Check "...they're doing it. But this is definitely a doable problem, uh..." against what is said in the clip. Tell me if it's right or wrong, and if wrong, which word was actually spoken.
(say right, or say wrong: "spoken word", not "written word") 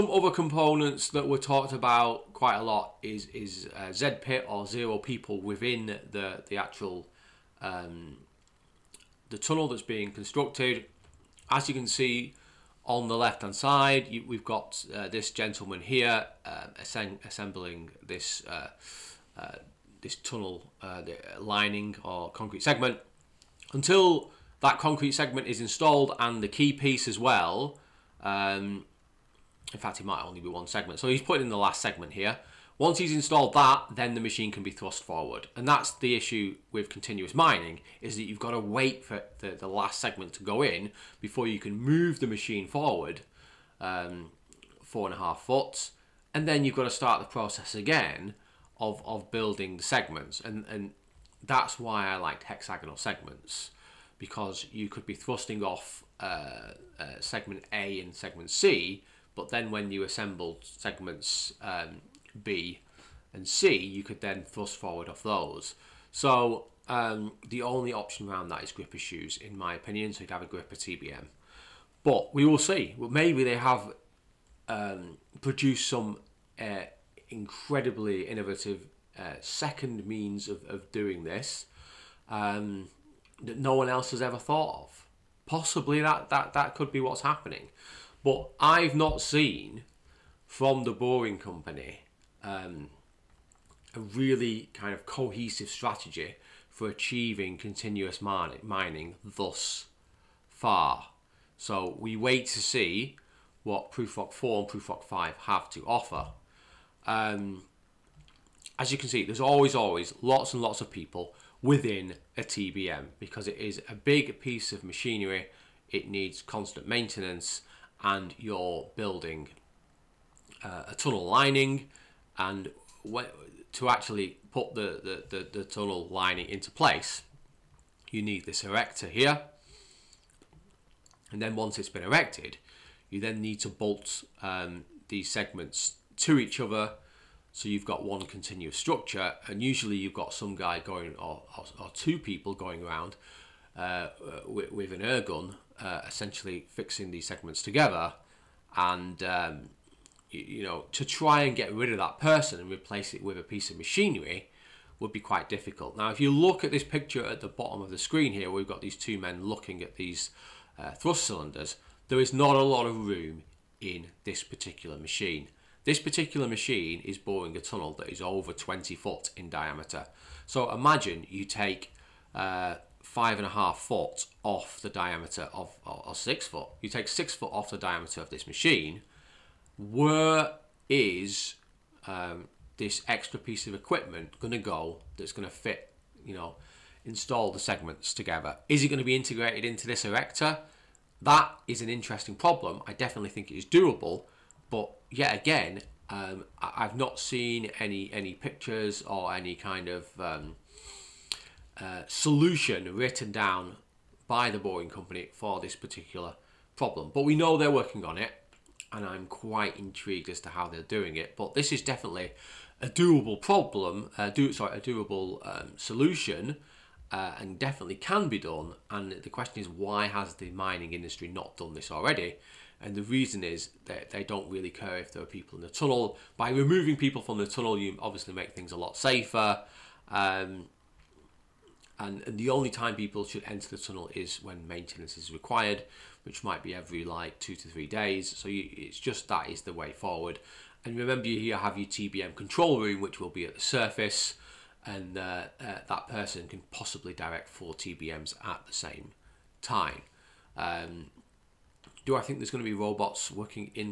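right.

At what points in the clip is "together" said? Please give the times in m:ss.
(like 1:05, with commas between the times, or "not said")
2:27, 3:08.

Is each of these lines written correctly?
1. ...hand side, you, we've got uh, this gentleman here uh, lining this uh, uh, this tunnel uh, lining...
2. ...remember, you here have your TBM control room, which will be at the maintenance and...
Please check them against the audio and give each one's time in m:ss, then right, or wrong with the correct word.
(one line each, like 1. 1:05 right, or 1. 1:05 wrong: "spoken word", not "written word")
1. 0:13 wrong: "assembling", not "lining"
2. 4:00 wrong: "surface", not "maintenance".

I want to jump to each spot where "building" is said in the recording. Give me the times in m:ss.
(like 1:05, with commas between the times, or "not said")
0:49, 1:58.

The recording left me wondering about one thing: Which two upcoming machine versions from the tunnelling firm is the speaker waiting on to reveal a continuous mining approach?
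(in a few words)
Prufrock 4 and Prufrock 5.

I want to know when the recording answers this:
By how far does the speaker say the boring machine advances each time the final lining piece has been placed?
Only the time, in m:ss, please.
0:44.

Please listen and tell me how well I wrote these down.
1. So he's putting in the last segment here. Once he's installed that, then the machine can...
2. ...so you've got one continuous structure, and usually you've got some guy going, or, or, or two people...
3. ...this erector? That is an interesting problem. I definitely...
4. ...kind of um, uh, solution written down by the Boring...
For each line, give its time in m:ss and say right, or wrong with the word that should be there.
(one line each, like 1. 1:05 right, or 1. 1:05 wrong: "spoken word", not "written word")
1. 0:30 right
2. 2:17 right
3. 3:09 right
4. 3:19 right.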